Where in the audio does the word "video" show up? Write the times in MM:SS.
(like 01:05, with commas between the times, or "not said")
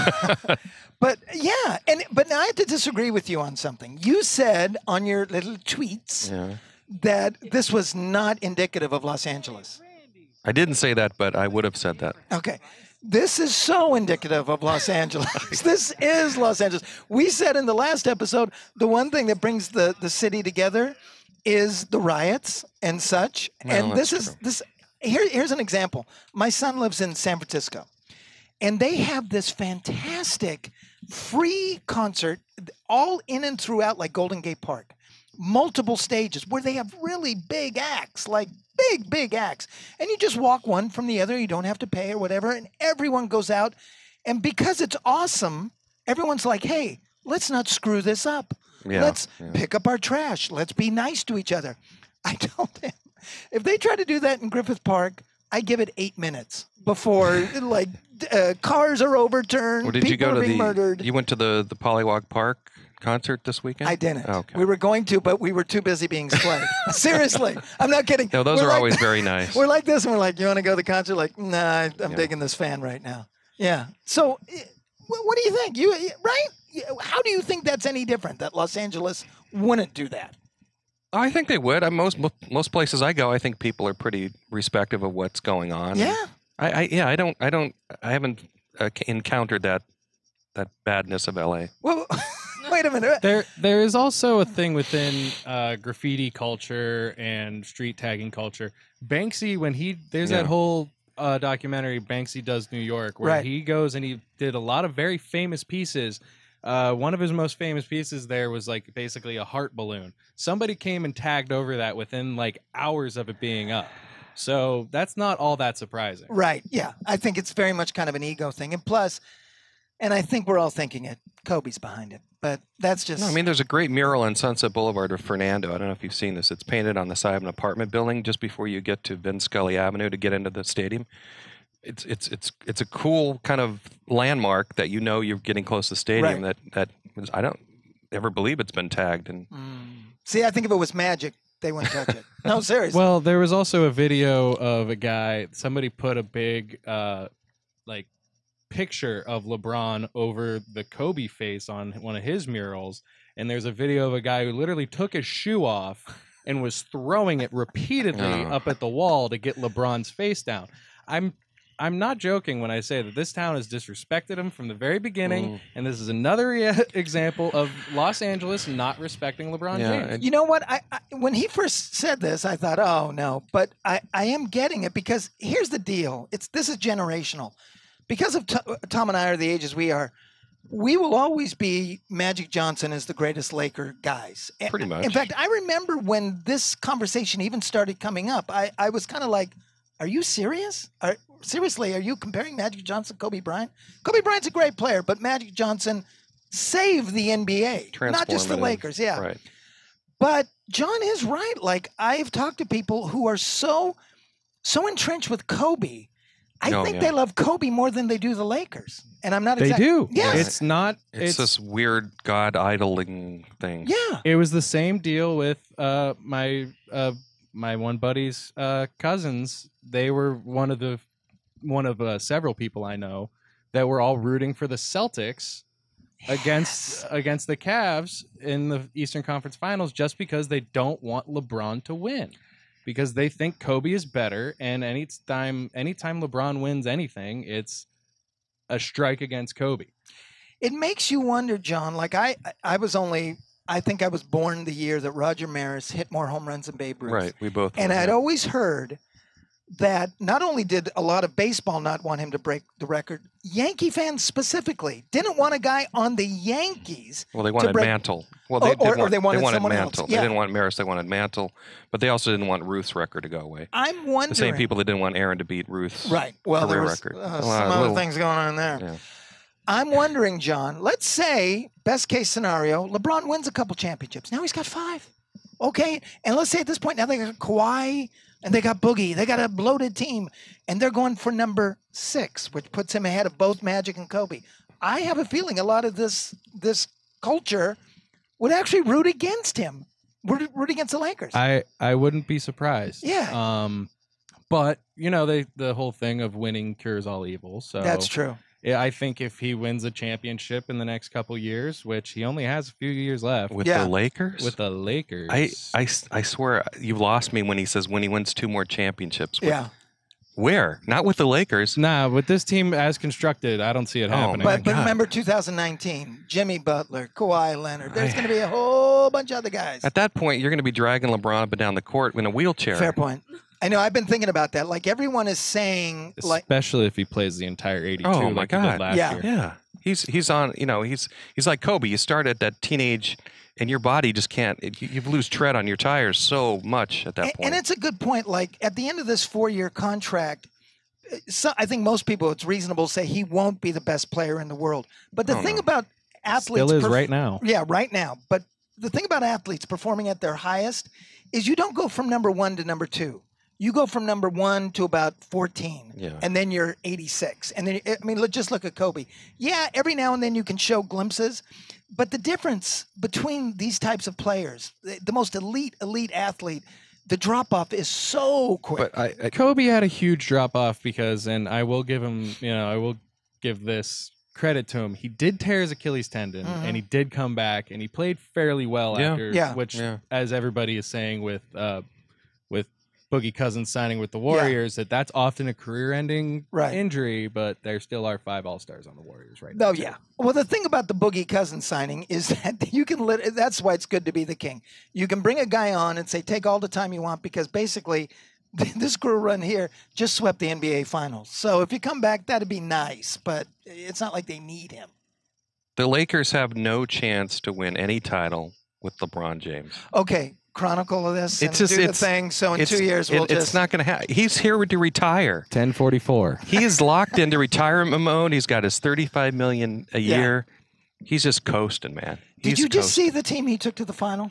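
02:23, 02:33.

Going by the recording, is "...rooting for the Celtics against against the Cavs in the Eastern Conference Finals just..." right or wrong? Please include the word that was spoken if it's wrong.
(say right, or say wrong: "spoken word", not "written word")
right.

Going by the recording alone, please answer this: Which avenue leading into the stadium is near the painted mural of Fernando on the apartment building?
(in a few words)
Vin Scully Avenue.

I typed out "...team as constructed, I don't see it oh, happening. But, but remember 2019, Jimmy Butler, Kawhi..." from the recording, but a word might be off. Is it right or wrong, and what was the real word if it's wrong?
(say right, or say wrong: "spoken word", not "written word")
right.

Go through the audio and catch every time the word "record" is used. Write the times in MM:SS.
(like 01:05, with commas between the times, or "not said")
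04:12, 04:22, 04:27.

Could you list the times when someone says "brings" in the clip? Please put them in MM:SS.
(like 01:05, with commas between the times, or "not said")
00:19, 06:35.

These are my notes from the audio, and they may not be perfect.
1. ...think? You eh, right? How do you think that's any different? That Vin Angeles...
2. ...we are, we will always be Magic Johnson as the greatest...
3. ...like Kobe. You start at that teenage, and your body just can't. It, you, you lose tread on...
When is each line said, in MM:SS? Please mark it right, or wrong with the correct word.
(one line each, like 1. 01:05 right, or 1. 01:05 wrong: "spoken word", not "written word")
1. 01:15 wrong: "Los", not "Vin"
2. 02:59 right
3. 05:31 right.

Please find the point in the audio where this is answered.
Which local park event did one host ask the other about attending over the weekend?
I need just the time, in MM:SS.
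01:01.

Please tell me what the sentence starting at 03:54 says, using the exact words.
And anytime anytime LeBron wins anything, it's a strike against Kobe.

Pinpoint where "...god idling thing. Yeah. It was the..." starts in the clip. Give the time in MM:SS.
03:32.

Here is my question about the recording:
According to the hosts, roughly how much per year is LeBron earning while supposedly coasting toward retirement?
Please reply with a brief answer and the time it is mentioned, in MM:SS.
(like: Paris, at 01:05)
35 million, at 06:58.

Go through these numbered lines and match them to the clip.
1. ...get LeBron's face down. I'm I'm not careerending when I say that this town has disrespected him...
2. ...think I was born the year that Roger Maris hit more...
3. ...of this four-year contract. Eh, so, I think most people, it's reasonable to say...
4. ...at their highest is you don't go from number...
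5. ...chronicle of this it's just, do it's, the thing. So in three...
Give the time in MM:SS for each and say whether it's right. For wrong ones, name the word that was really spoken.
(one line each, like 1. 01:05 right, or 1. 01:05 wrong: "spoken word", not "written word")
1. 02:39 wrong: "joking", not "careerending"
2. 04:03 right
3. 05:38 right
4. 05:50 right
5. 06:50 wrong: "two", not "three".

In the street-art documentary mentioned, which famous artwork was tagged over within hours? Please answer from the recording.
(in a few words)
heart balloon.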